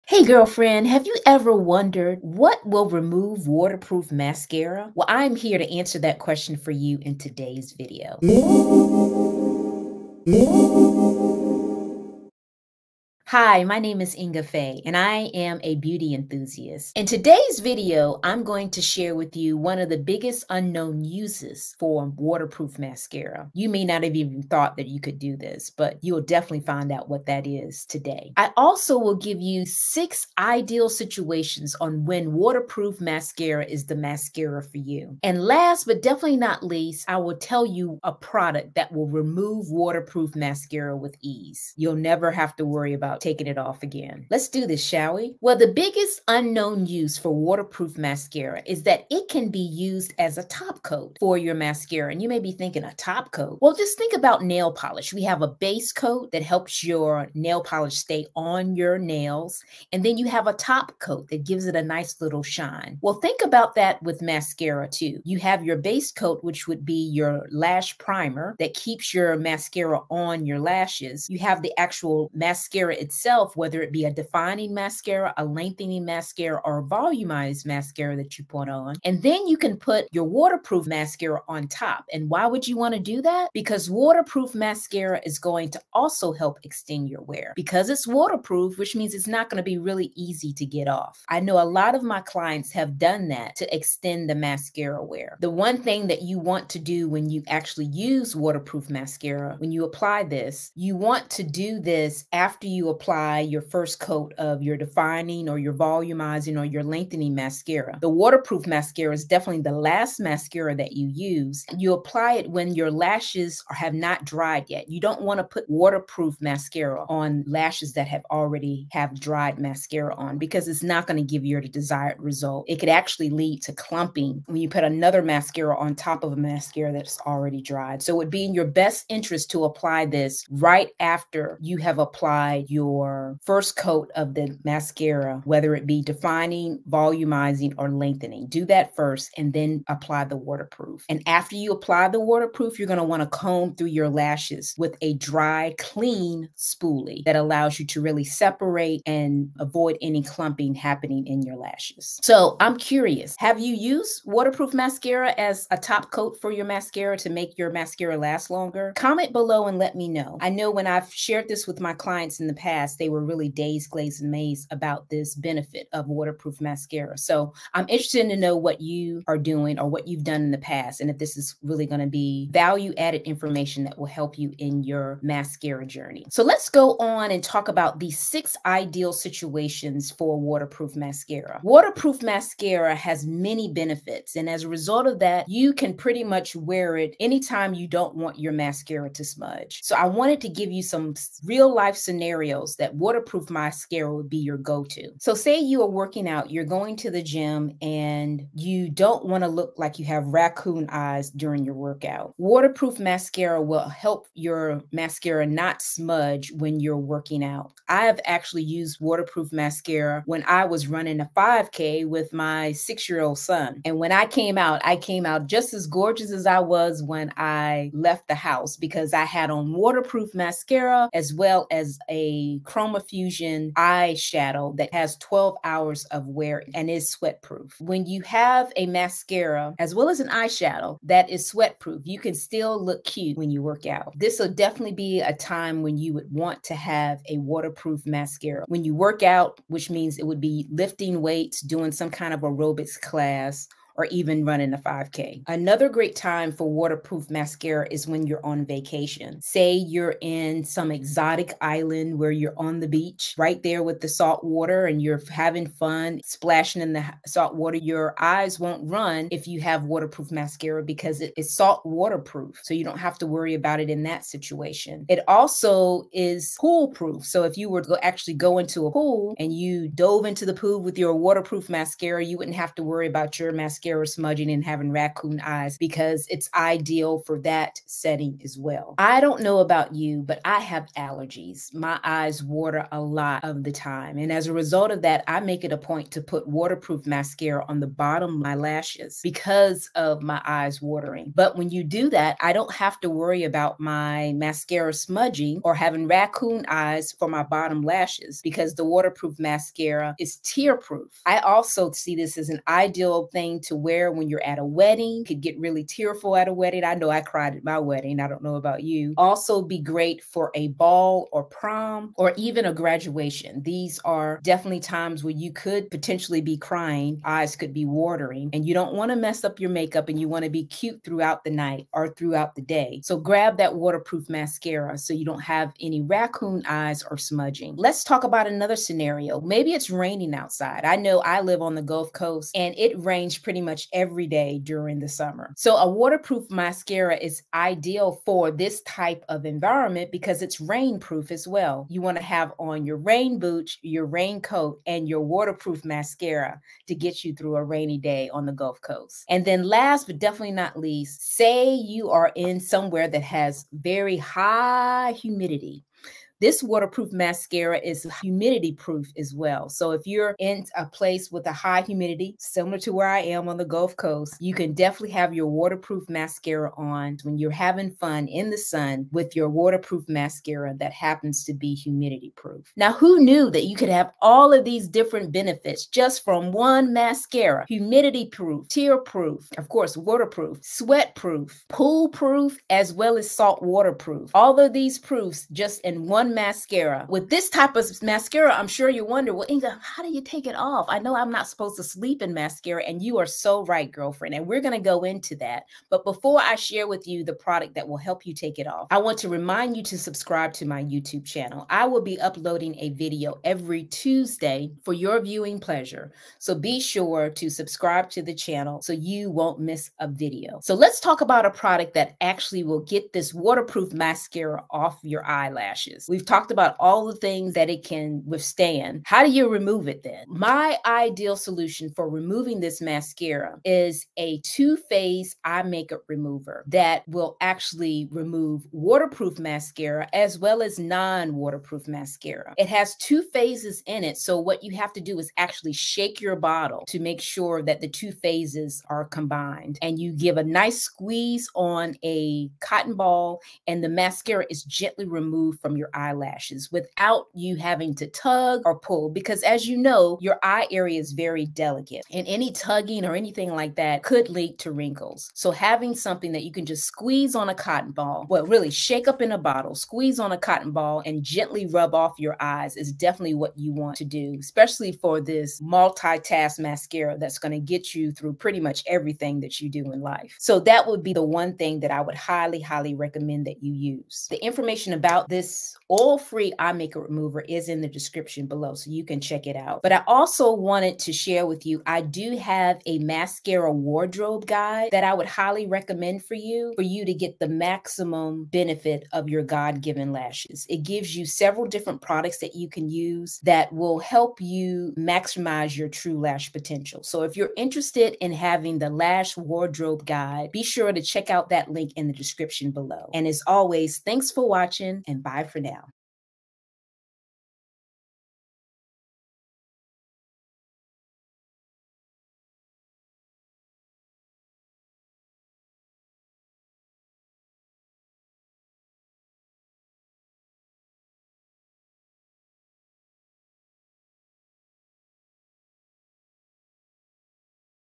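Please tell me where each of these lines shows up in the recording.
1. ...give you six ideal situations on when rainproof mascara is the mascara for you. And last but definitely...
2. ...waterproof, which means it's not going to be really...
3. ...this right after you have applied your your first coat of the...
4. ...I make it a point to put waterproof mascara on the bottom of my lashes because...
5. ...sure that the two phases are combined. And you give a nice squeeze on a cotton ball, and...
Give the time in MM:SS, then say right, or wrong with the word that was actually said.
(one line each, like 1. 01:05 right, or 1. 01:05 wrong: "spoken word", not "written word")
1. 00:29 wrong: "waterproof", not "rainproof"
2. 01:28 right
3. 02:10 right
4. 04:45 right
5. 07:17 right.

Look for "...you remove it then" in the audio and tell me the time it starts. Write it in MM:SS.
06:59.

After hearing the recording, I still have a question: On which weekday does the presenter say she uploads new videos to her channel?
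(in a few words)
Tuesday.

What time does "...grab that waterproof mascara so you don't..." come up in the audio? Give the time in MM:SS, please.
05:23.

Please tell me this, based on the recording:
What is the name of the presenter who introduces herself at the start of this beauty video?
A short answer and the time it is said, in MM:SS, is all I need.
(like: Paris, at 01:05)
Inga Fay, at 00:14.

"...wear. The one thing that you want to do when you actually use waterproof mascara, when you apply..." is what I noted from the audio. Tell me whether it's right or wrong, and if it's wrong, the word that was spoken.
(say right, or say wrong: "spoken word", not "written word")
right.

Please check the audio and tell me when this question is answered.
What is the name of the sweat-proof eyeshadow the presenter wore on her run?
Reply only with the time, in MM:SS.
03:42.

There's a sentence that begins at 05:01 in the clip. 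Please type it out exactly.
I also see this as an ideal thing to to wear when you're at a wedding.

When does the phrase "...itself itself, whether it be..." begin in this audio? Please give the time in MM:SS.
01:12.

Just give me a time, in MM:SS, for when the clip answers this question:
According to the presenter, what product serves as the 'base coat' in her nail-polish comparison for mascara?
01:07.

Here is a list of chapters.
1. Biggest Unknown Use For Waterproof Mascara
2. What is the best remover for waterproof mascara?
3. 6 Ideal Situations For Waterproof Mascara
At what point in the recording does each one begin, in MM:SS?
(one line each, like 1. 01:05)
1. 00:47
2. 06:48
3. 02:58.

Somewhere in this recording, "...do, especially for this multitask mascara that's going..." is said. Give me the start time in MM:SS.
07:44.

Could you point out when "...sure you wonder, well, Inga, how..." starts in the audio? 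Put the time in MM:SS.
06:28.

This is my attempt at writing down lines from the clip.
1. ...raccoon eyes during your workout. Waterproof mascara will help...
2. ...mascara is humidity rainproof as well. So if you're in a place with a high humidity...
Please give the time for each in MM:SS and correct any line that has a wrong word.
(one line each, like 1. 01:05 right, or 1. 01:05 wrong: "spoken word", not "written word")
1. 03:20 right
2. 05:57 wrong: "proof", not "rainproof".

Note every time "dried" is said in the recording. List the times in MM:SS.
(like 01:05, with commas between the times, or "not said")
01:54, 01:59, 02:07.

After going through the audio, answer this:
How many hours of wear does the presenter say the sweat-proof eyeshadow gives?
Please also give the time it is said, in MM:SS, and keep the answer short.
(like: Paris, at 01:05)
12, at 03:45.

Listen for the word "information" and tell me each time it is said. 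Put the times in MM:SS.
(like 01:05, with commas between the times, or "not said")
02:53, 07:54.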